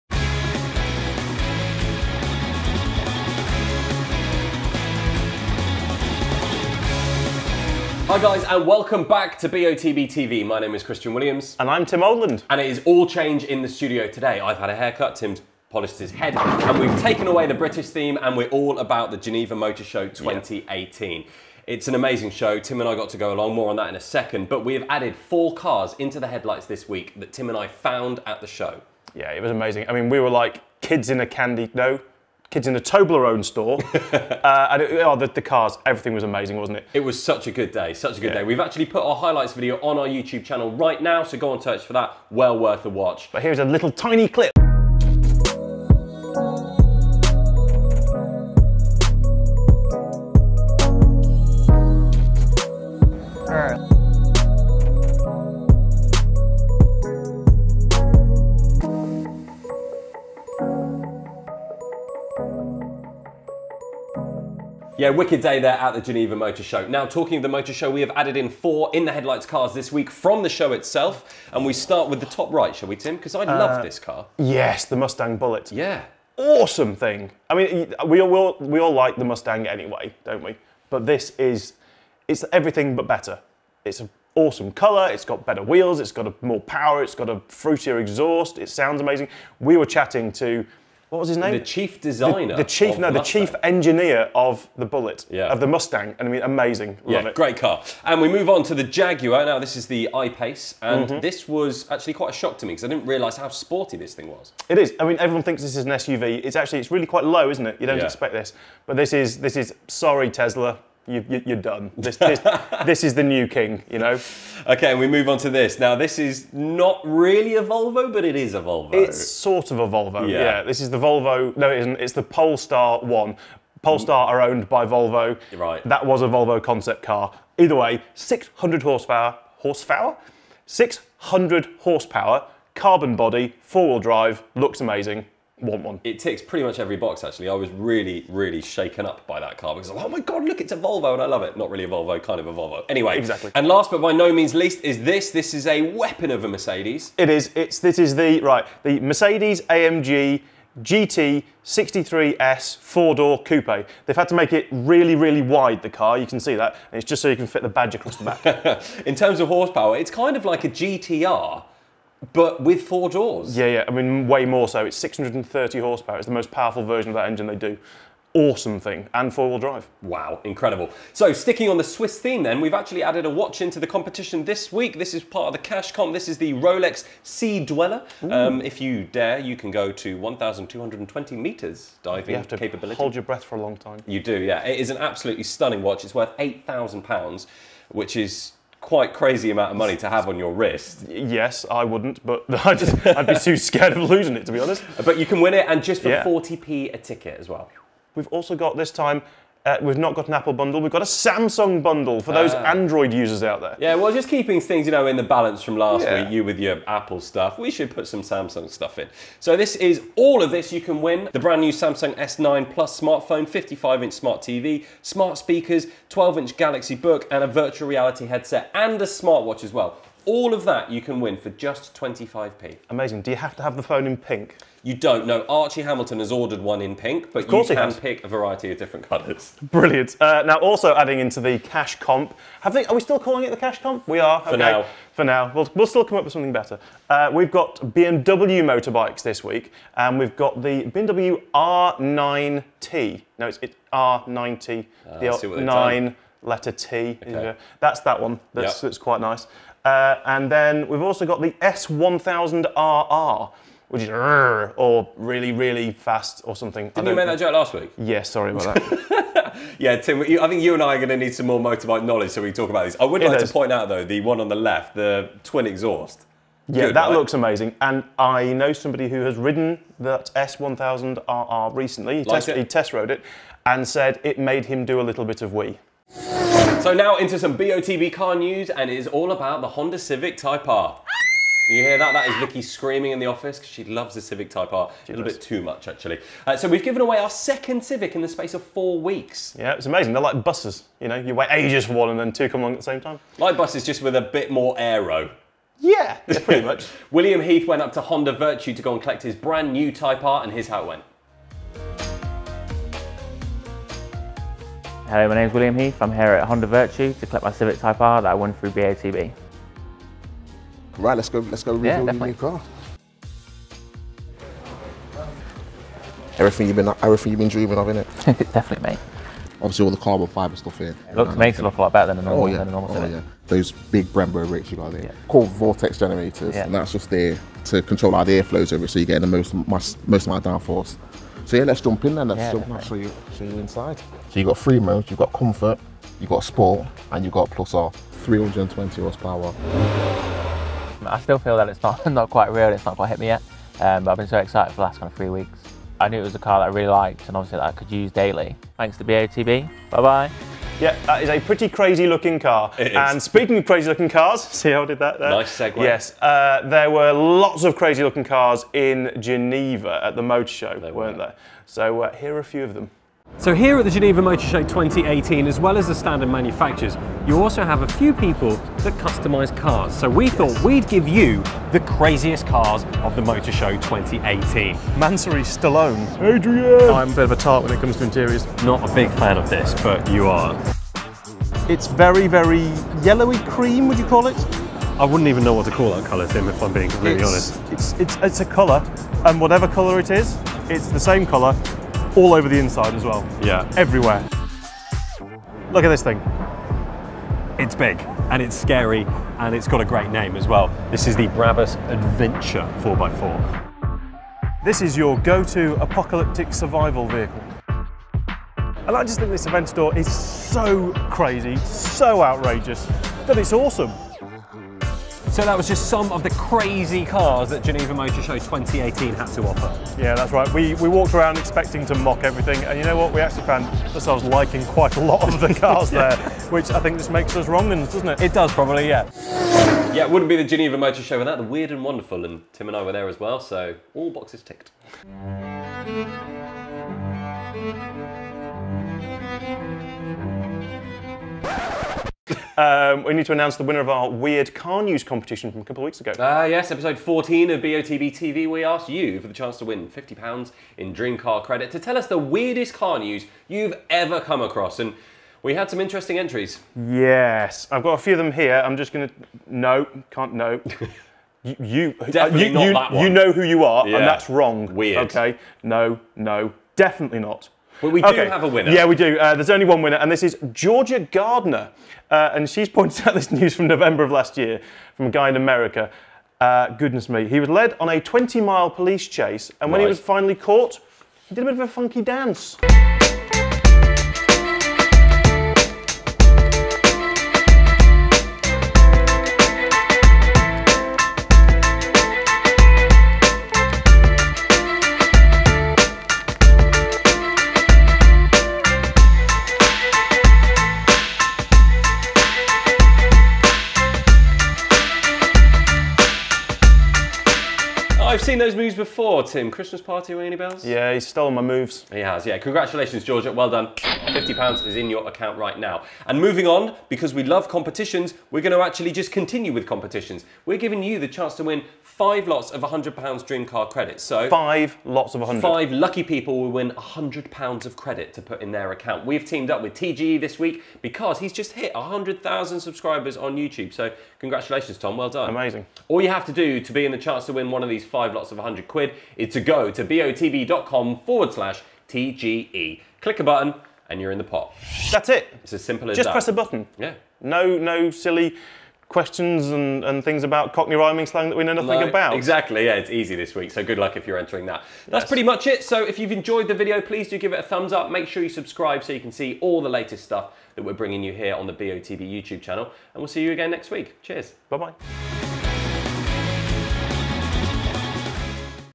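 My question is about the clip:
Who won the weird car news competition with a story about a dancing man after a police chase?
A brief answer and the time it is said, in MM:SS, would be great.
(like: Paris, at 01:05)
Georgia Gardner, at 07:50.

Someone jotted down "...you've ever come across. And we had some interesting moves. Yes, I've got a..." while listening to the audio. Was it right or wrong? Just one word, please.
wrong.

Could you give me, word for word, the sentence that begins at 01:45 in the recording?
I mean, everyone thinks this is an SUV.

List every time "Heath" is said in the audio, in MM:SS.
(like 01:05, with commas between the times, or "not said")
04:57, 05:05.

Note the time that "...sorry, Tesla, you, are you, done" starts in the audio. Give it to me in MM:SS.
01:49.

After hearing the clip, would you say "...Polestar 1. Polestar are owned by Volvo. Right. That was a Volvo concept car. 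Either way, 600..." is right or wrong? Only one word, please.
right.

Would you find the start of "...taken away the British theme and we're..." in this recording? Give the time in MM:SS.
00:16.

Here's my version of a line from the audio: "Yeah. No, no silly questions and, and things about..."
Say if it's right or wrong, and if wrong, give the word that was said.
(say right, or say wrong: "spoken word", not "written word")
right.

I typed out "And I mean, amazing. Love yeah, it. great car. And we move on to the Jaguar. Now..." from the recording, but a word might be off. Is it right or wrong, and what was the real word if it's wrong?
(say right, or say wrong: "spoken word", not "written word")
right.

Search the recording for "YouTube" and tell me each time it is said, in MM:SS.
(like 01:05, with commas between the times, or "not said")
00:40, 08:53, 09:22.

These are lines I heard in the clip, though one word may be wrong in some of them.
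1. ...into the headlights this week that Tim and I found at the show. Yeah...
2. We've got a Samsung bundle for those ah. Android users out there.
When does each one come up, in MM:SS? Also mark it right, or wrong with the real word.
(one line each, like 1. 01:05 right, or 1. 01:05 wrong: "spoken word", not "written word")
1. 00:25 right
2. 03:20 right.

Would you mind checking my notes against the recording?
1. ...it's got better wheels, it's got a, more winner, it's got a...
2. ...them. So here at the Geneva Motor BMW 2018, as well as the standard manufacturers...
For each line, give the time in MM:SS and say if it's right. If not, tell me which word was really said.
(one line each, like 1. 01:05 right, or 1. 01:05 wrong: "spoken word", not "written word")
1. 01:25 wrong: "power", not "winner"
2. 06:02 wrong: "Show", not "BMW".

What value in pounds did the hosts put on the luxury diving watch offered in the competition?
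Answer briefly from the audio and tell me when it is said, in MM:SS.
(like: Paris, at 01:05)
£8,000, at 03:06.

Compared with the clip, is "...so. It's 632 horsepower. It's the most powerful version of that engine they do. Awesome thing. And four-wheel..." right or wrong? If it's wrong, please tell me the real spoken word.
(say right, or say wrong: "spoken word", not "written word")
wrong: "630", not "632".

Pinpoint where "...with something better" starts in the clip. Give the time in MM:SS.
03:56.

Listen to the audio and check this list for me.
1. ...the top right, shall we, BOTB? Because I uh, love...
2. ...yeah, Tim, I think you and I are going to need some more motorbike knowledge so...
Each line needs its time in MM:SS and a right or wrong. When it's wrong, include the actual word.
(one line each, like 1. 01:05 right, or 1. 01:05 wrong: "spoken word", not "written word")
1. 01:12 wrong: "Tim", not "BOTB"
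2. 04:19 right.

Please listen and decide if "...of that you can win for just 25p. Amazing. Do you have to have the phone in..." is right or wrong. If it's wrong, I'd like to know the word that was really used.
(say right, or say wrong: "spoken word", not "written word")
right.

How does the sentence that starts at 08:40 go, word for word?
We're giving you the chance to win five lots of £100 dream car credit.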